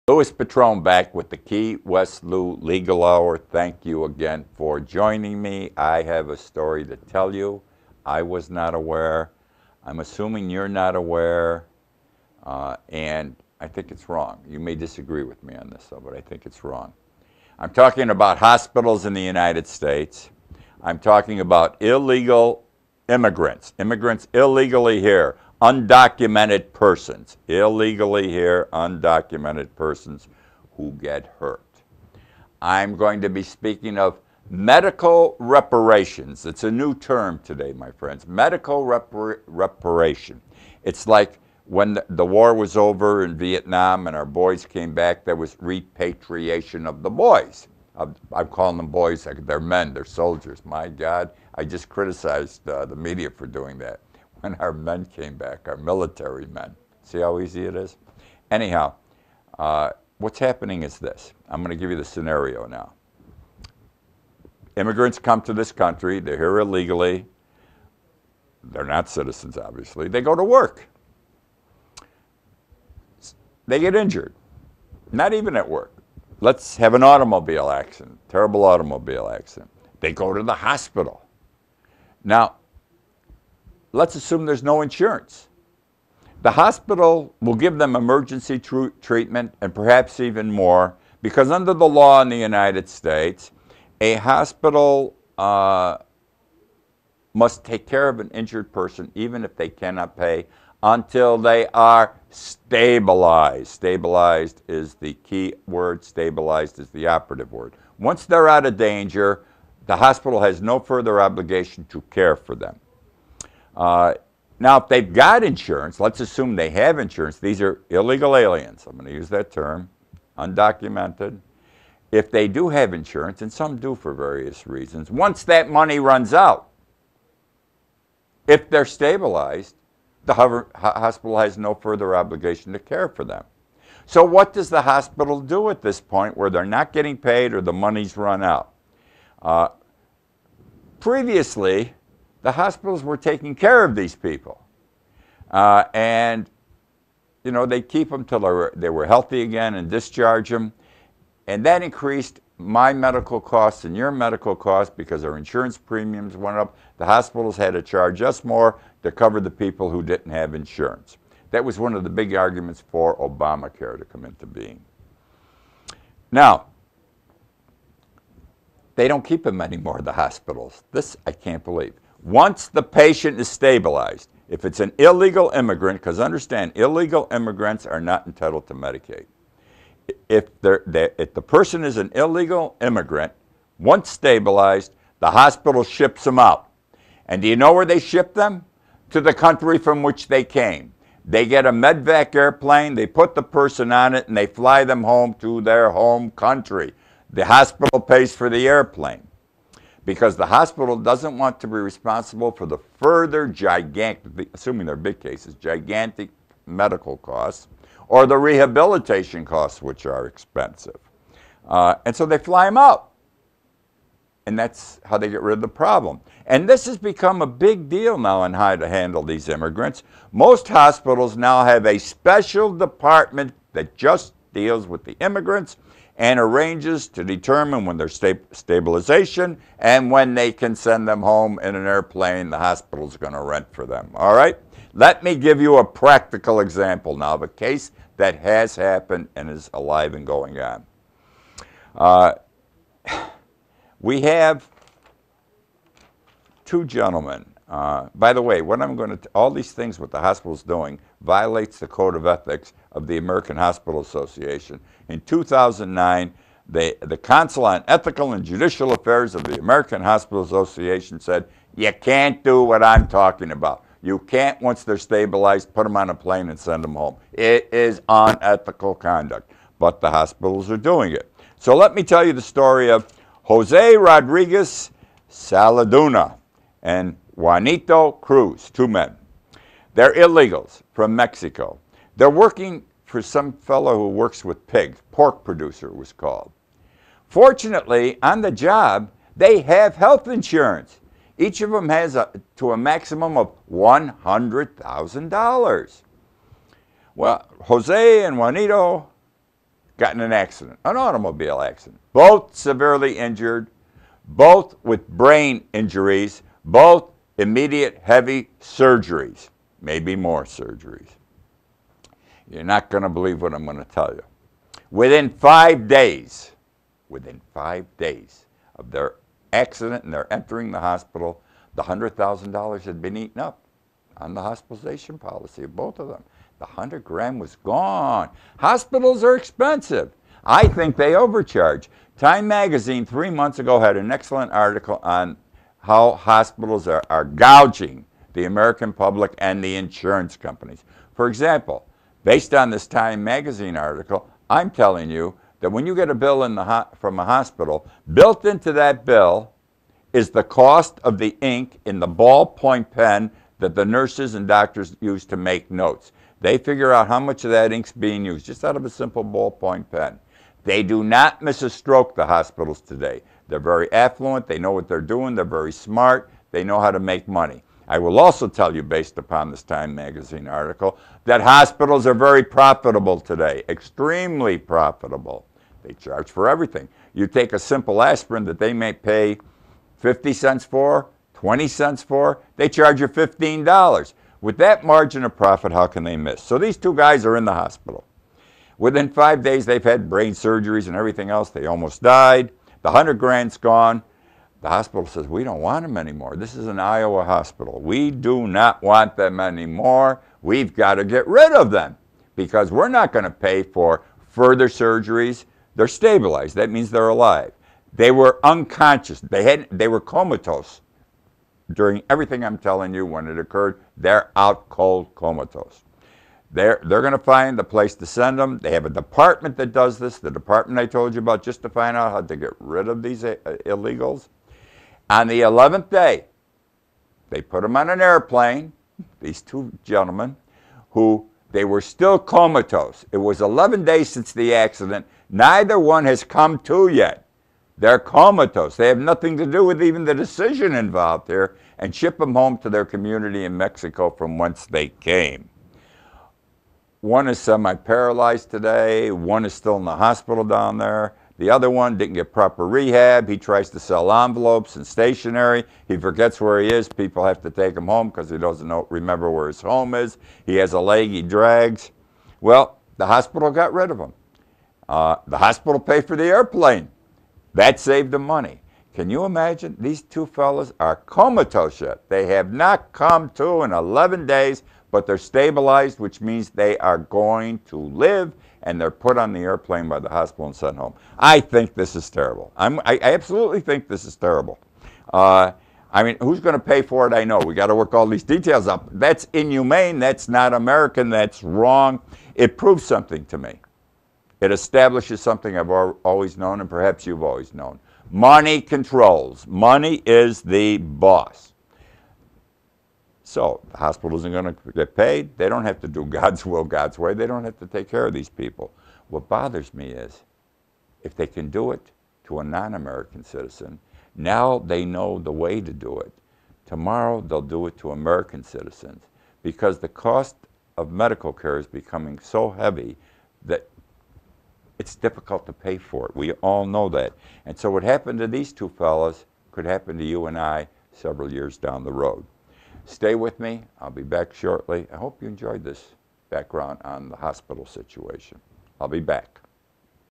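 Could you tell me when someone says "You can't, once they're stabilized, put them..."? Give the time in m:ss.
4:24.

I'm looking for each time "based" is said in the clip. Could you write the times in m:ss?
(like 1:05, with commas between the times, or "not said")
5:42, 6:08.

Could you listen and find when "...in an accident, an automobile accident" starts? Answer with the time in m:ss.
5:00.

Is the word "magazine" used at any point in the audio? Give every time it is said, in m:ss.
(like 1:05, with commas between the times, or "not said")
5:32, 5:43, 6:09.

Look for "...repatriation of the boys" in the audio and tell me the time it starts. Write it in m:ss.
0:45.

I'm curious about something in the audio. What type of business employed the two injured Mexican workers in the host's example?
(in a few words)
Pork producer.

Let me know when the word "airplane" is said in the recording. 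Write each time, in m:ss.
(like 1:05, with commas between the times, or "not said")
3:12, 3:18, 3:51, 7:07, 7:46, 7:59.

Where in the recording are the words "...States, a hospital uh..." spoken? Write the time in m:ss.
1:32.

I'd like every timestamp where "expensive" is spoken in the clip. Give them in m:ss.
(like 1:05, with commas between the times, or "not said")
3:30, 5:29.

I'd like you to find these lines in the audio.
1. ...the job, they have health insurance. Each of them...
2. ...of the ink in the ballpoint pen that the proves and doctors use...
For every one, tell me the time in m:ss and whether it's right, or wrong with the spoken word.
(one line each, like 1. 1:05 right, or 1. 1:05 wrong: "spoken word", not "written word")
1. 4:48 right
2. 5:51 wrong: "nurses", not "proves".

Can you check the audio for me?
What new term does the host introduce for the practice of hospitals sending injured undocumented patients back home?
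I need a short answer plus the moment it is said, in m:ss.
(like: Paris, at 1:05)
Medical reparation, at 0:38.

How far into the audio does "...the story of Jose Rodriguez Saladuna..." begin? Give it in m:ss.
4:32.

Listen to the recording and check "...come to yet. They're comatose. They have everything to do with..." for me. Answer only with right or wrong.
wrong.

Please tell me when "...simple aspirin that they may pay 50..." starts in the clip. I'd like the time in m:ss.
6:17.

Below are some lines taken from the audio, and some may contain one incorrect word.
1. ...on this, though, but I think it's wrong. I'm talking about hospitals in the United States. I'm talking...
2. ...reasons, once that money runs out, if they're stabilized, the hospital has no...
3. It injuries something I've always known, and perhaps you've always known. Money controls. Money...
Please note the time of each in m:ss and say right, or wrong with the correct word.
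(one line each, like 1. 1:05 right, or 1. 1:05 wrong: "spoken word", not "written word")
1. 0:15 right
2. 2:04 right
3. 8:14 wrong: "establishes", not "injuries".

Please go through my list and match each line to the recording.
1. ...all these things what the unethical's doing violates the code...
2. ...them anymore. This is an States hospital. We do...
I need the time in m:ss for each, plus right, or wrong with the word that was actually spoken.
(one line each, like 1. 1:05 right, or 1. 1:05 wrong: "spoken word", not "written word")
1. 4:09 wrong: "hospital", not "unethical"
2. 6:35 wrong: "Iowa", not "States".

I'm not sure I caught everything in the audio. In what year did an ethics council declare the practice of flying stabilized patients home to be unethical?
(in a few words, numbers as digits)
2009.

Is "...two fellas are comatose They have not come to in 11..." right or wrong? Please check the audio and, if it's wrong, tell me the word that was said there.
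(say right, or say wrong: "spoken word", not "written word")
right.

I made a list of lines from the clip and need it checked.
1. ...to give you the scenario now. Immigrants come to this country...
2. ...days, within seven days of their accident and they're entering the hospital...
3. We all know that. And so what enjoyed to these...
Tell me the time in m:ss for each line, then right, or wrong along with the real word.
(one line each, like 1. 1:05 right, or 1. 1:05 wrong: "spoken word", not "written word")
1. 1:01 right
2. 5:15 wrong: "five", not "seven"
3. 8:46 wrong: "happened", not "enjoyed".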